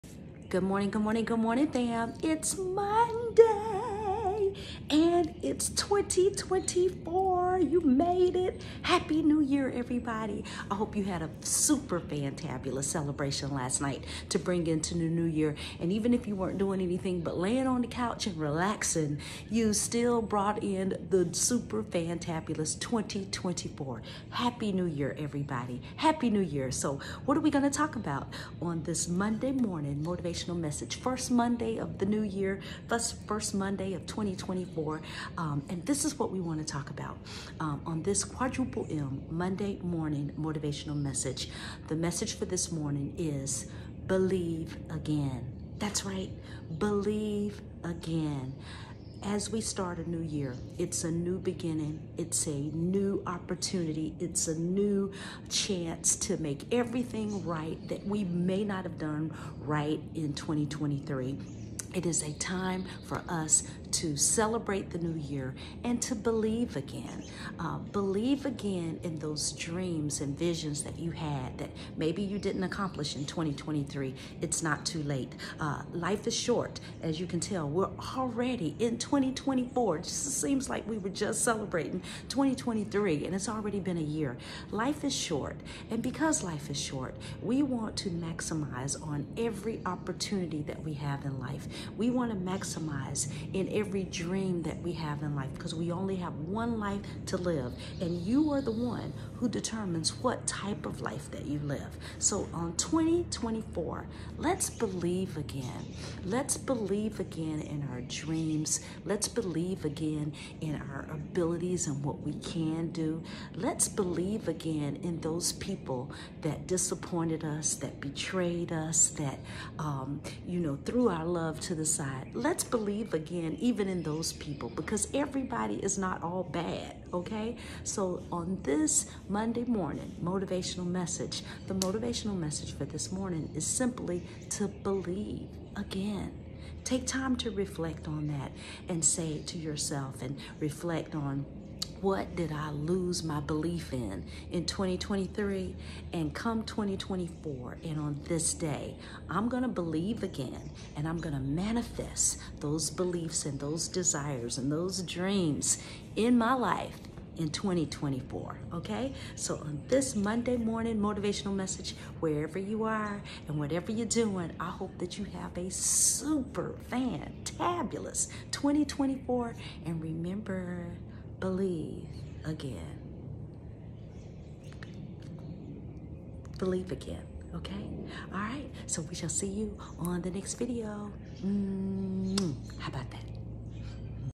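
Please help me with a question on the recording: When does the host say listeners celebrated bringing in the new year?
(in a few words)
last night.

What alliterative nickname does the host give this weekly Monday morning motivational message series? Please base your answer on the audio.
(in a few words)
quadruple M.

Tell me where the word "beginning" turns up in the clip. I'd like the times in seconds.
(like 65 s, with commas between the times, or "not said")
51 s.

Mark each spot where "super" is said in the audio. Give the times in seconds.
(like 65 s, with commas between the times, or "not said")
11 s, 21 s, 165 s.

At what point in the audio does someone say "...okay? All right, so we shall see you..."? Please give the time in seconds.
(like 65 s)
177 s.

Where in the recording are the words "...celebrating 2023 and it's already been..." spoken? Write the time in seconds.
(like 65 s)
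81 s.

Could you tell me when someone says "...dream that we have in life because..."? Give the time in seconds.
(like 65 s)
94 s.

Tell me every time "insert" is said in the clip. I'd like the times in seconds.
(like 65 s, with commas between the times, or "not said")
not said.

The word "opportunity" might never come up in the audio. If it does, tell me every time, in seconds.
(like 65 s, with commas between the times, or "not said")
53 s, 89 s.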